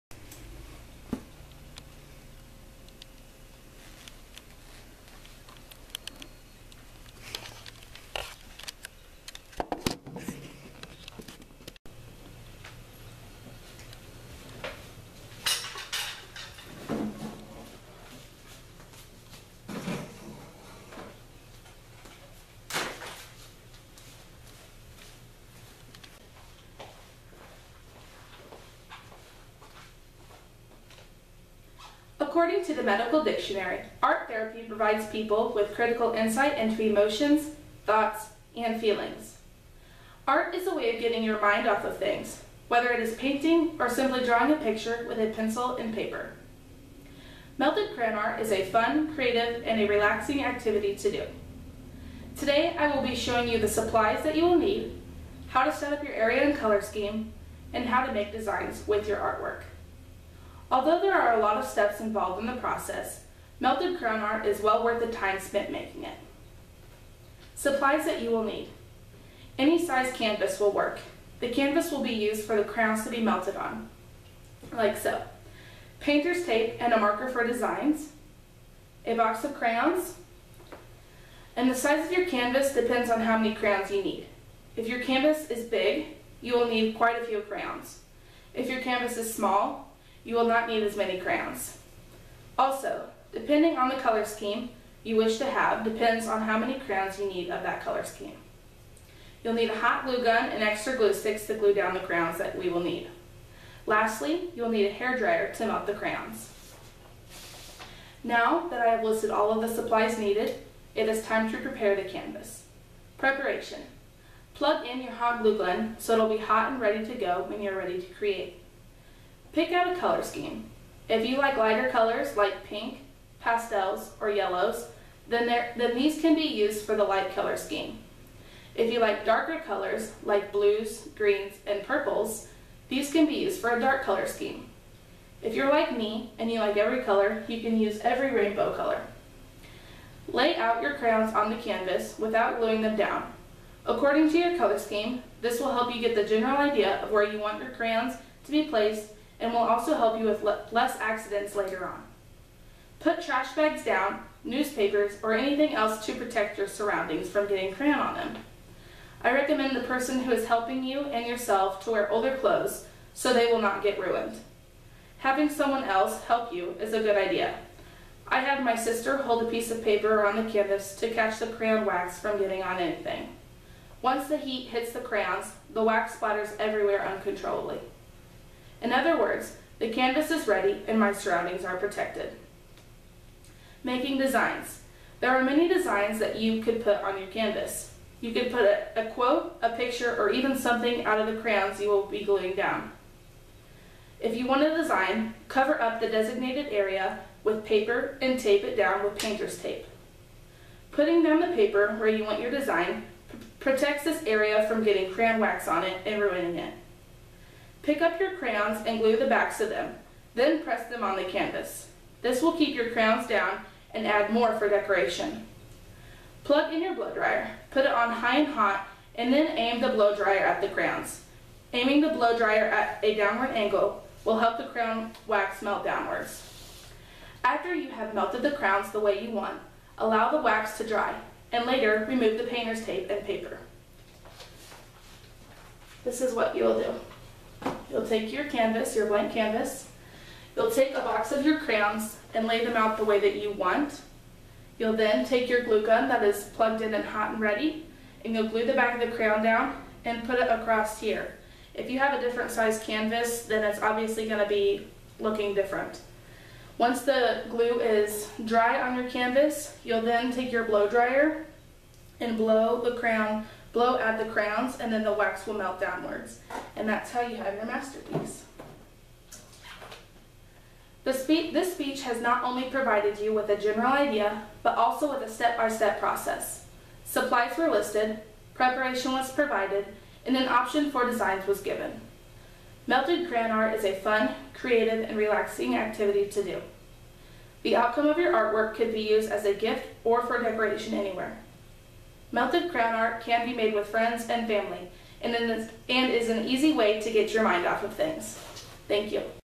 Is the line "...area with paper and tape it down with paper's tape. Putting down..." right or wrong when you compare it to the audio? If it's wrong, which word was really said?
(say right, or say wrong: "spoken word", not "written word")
wrong: "painter", not "paper".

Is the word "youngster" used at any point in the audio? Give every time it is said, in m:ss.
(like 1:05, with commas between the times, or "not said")
not said.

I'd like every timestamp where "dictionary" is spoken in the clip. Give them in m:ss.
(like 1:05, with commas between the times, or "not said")
0:33.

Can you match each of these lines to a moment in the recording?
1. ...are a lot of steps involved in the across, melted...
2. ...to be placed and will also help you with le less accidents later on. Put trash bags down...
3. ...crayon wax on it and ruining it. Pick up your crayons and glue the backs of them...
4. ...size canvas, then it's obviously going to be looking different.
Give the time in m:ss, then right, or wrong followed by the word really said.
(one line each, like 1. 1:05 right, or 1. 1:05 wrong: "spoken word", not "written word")
1. 1:01 wrong: "process", not "across"
2. 2:28 right
3. 3:25 right
4. 4:12 right.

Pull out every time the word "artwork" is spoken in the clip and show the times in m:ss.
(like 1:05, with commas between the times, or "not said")
0:59, 4:48.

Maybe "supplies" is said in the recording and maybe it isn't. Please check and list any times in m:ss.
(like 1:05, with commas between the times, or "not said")
0:53, 1:07, 1:49, 4:37.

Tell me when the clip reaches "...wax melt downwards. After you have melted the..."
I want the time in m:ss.
3:45.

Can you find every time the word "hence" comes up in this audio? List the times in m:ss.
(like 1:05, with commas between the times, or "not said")
not said.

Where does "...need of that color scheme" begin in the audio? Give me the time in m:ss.
1:37.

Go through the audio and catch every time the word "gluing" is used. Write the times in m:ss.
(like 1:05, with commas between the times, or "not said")
2:22, 3:12.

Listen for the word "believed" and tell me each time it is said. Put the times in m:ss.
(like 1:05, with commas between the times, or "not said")
not said.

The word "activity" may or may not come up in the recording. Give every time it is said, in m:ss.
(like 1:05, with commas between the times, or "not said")
0:50, 4:45.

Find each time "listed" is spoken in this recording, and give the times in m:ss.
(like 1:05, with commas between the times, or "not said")
1:49, 4:37.